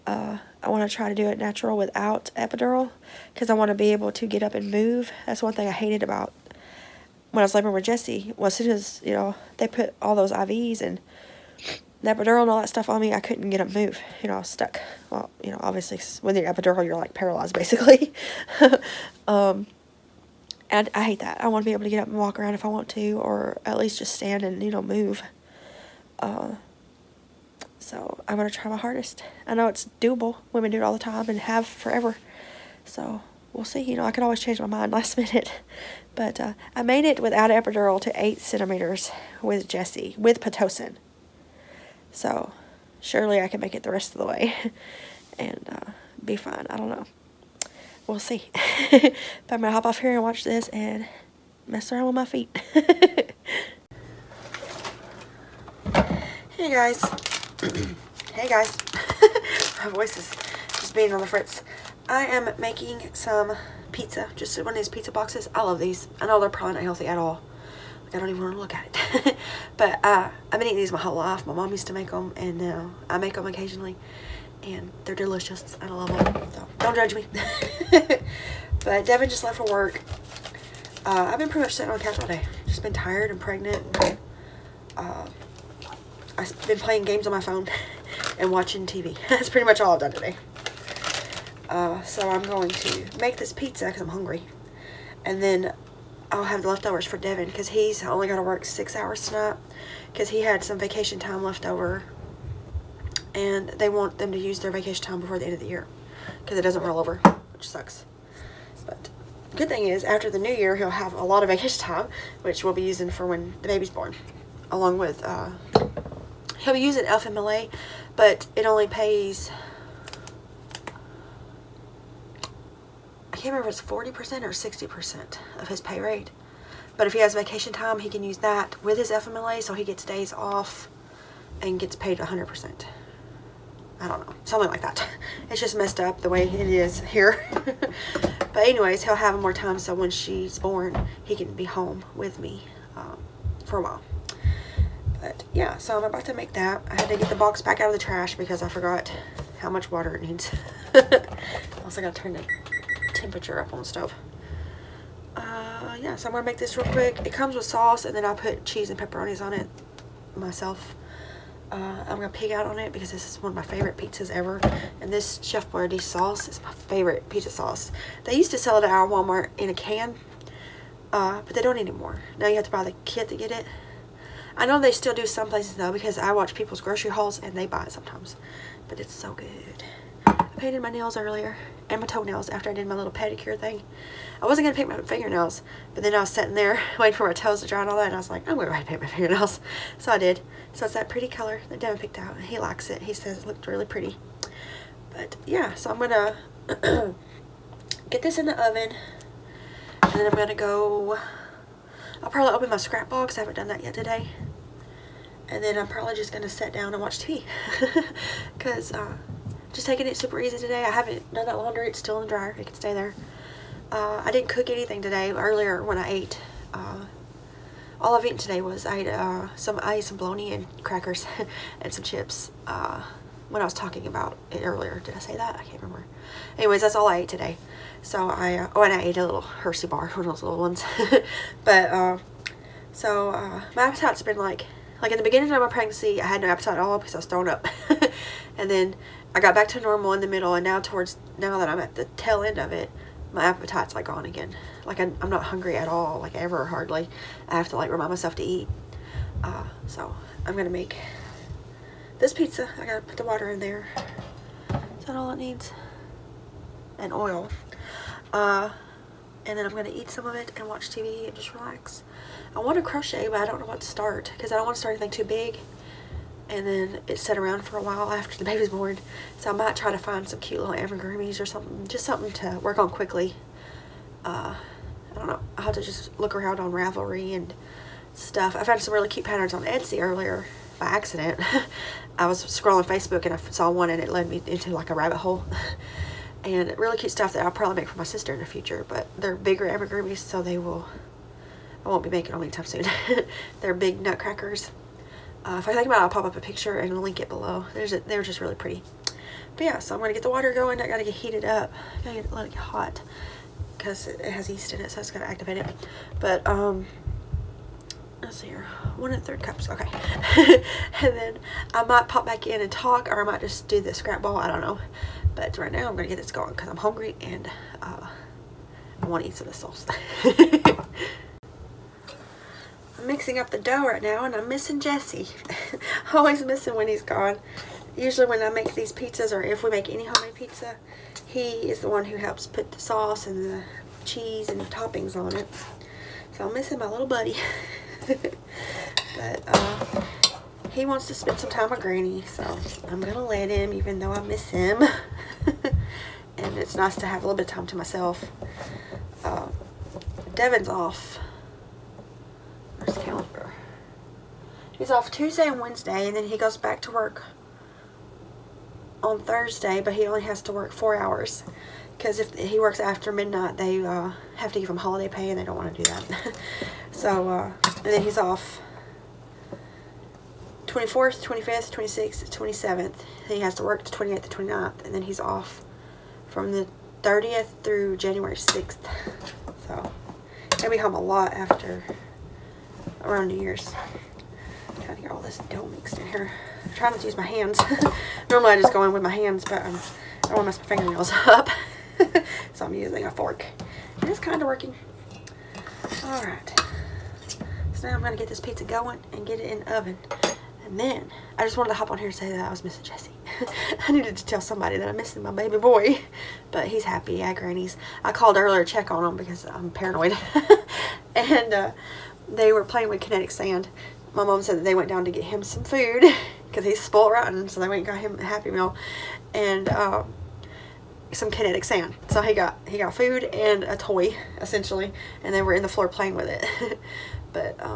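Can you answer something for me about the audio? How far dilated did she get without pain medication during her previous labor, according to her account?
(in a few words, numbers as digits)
8 centimeters.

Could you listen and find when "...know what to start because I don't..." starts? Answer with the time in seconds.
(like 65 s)
263 s.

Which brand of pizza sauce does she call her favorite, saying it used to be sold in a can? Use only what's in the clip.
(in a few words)
Chef Boyardee.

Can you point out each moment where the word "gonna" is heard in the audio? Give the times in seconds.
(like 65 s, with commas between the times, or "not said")
206 s, 250 s, 259 s.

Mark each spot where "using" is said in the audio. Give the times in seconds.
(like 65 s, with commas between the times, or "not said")
112 s, 392 s.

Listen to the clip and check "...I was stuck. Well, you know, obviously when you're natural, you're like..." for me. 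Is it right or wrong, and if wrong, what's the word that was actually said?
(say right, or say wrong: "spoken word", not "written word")
wrong: "epidural", not "natural".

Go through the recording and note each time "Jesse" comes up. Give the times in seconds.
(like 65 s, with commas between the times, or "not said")
7 s, 39 s, 324 s, 402 s.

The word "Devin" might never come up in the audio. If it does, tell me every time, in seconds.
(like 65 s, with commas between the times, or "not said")
79 s, 97 s, 191 s, 350 s.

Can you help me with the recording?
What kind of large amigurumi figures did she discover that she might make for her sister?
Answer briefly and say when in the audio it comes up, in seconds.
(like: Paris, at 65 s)
Nutcrackers, at 294 s.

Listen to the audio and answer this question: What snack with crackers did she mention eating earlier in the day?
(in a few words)
Bologna.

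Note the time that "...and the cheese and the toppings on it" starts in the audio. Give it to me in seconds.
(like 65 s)
333 s.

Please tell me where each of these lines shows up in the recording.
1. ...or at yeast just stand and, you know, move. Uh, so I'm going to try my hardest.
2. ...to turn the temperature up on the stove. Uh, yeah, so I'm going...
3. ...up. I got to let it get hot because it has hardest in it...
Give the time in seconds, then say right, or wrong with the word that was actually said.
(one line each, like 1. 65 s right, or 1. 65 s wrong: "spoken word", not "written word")
1. 23 s wrong: "least", not "yeast"
2. 152 s right
3. 301 s wrong: "yeast", not "hardest".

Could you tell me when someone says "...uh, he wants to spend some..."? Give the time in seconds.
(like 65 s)
339 s.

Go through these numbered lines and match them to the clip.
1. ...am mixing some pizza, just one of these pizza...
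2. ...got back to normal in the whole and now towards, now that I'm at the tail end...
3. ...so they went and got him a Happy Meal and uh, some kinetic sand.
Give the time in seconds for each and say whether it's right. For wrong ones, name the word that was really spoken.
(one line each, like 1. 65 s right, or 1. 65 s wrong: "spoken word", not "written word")
1. 62 s wrong: "making", not "mixing"
2. 239 s wrong: "middle", not "whole"
3. 417 s right.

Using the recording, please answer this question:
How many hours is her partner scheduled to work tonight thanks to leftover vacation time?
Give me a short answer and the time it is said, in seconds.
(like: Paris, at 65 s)
6, at 98 s.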